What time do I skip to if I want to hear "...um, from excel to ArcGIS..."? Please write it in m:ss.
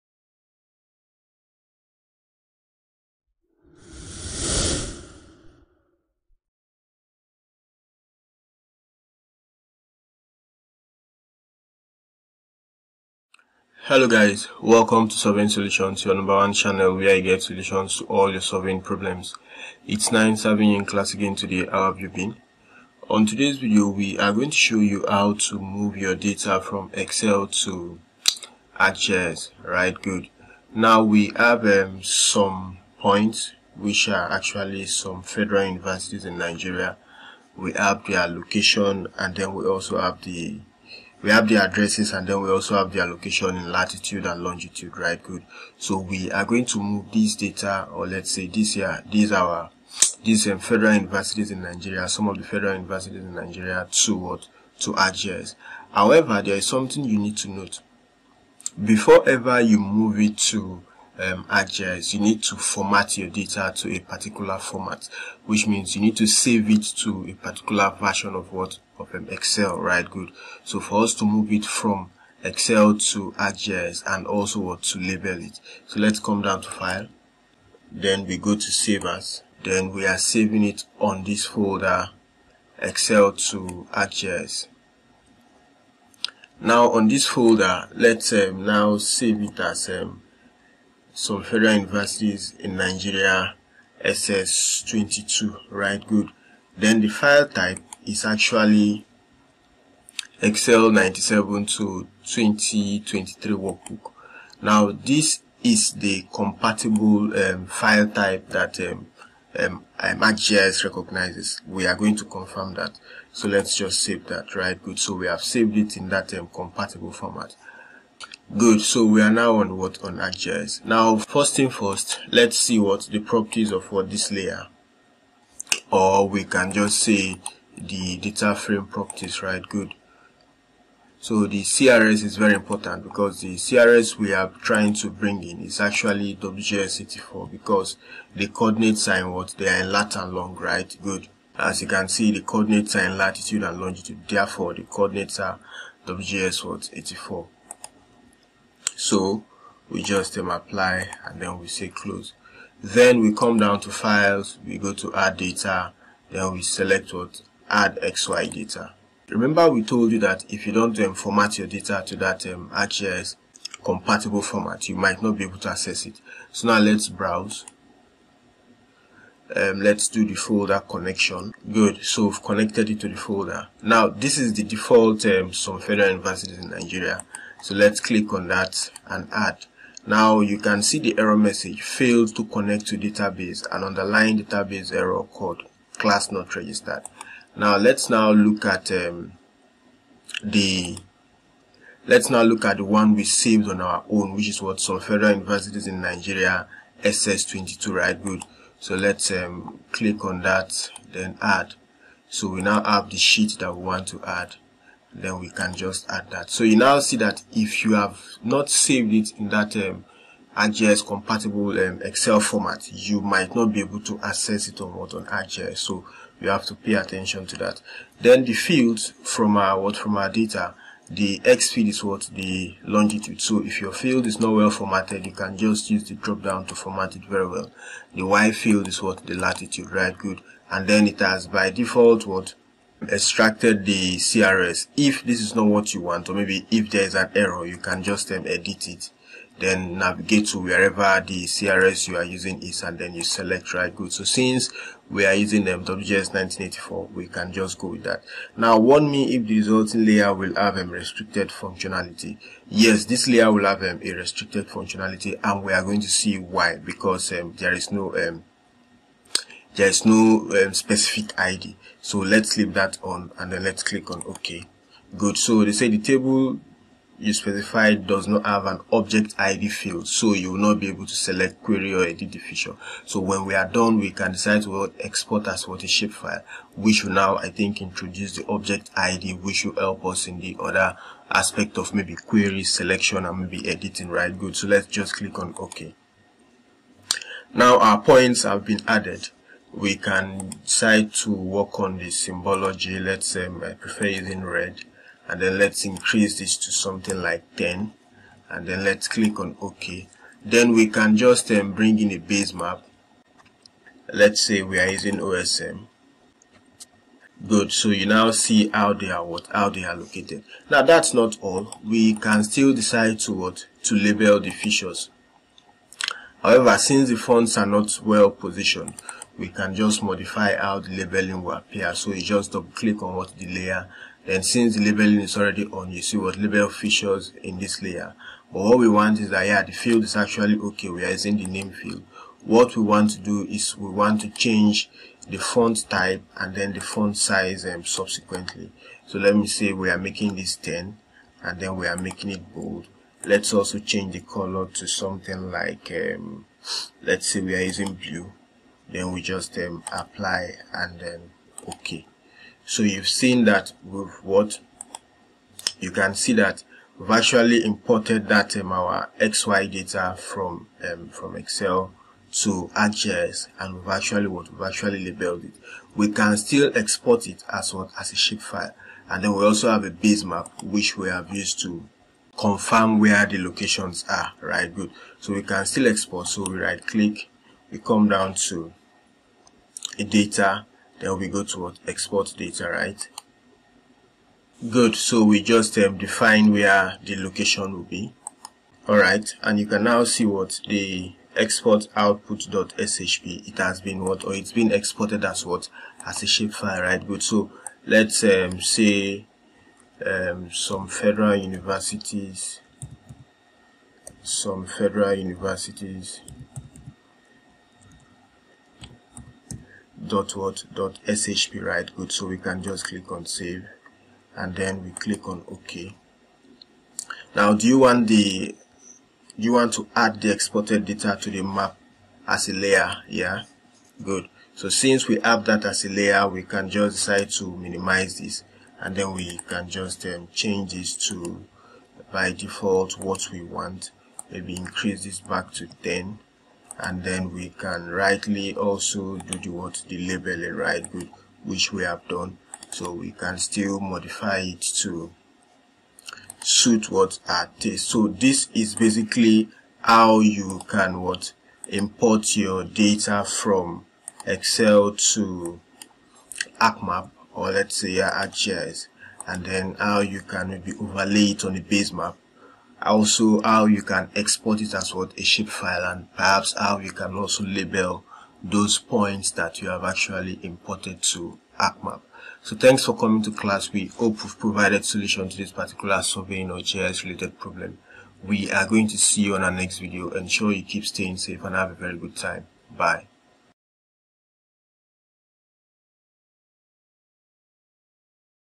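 6:00.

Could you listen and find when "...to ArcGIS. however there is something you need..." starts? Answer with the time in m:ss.
0:54.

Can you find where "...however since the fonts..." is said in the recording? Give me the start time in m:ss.
5:16.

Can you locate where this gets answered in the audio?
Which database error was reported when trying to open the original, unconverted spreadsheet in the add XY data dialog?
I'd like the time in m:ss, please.
3:05.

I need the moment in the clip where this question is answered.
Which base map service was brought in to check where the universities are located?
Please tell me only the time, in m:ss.
5:05.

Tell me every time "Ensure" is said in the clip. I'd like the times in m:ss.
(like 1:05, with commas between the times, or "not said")
8:00.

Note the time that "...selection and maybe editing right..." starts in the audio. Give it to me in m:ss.
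4:42.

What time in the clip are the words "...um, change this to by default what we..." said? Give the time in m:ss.
7:10.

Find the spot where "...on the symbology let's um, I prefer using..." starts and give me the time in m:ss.
4:51.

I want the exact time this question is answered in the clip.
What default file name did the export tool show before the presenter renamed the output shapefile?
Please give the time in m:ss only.
6:31.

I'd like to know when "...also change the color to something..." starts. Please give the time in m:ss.
5:43.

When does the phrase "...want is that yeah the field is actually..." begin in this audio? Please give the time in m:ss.
5:28.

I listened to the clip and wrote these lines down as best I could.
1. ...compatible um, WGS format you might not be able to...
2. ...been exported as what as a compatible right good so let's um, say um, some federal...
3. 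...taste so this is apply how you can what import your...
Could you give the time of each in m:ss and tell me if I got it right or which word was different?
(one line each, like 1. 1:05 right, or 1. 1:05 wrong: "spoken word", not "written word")
1. 3:31 wrong: "Excel", not "WGS"
2. 6:34 wrong: "shapefile", not "compatible"
3. 7:27 wrong: "basically", not "apply".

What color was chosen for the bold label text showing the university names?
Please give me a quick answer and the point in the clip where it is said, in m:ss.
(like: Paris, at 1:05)
blue, at 5:47.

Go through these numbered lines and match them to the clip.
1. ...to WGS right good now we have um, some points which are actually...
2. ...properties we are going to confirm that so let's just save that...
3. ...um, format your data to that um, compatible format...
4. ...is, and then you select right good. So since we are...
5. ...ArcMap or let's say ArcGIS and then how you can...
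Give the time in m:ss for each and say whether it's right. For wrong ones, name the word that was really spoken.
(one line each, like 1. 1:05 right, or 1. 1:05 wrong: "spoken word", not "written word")
1. 0:27 wrong: "ArcGIS", not "WGS"
2. 1:50 wrong: "recognizes", not "properties"
3. 2:40 right
4. 4:02 right
5. 7:36 right.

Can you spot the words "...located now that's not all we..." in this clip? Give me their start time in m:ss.
5:09.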